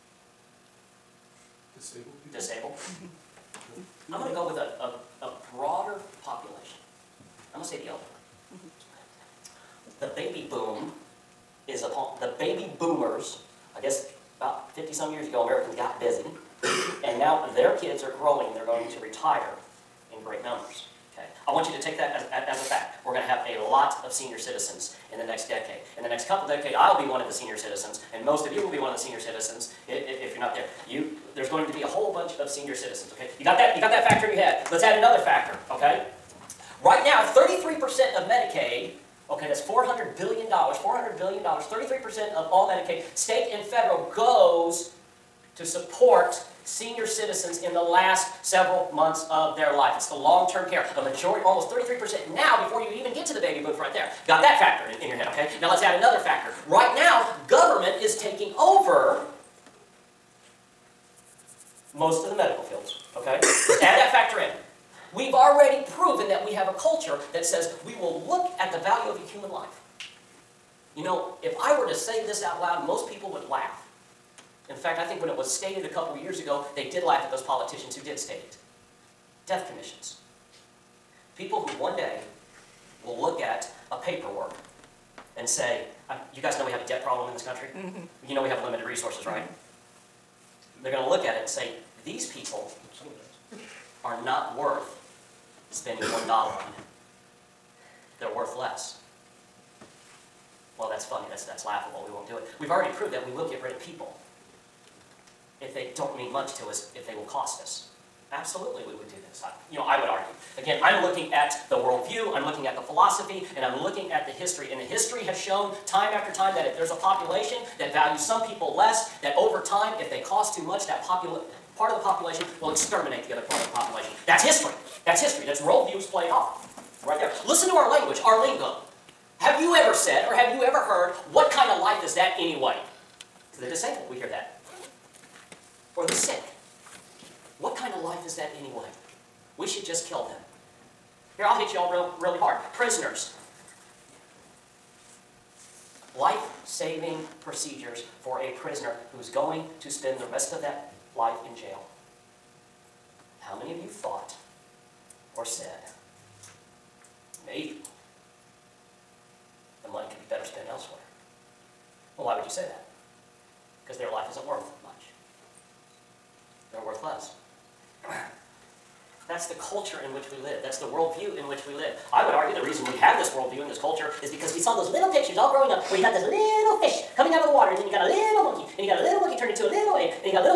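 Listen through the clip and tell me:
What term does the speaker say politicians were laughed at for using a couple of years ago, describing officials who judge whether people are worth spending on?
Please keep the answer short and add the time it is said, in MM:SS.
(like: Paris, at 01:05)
Death commissions, at 01:19.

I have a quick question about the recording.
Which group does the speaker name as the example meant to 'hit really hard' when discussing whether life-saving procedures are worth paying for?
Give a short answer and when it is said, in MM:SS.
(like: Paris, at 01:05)
Prisoners, at 02:22.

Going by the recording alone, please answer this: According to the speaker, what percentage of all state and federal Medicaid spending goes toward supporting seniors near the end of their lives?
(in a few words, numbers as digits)
33%.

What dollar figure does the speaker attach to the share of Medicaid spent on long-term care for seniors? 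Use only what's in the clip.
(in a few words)
$400 billion.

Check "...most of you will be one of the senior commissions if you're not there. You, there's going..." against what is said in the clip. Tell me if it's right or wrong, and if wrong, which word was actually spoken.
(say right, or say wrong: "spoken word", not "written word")
wrong: "citizens", not "commissions".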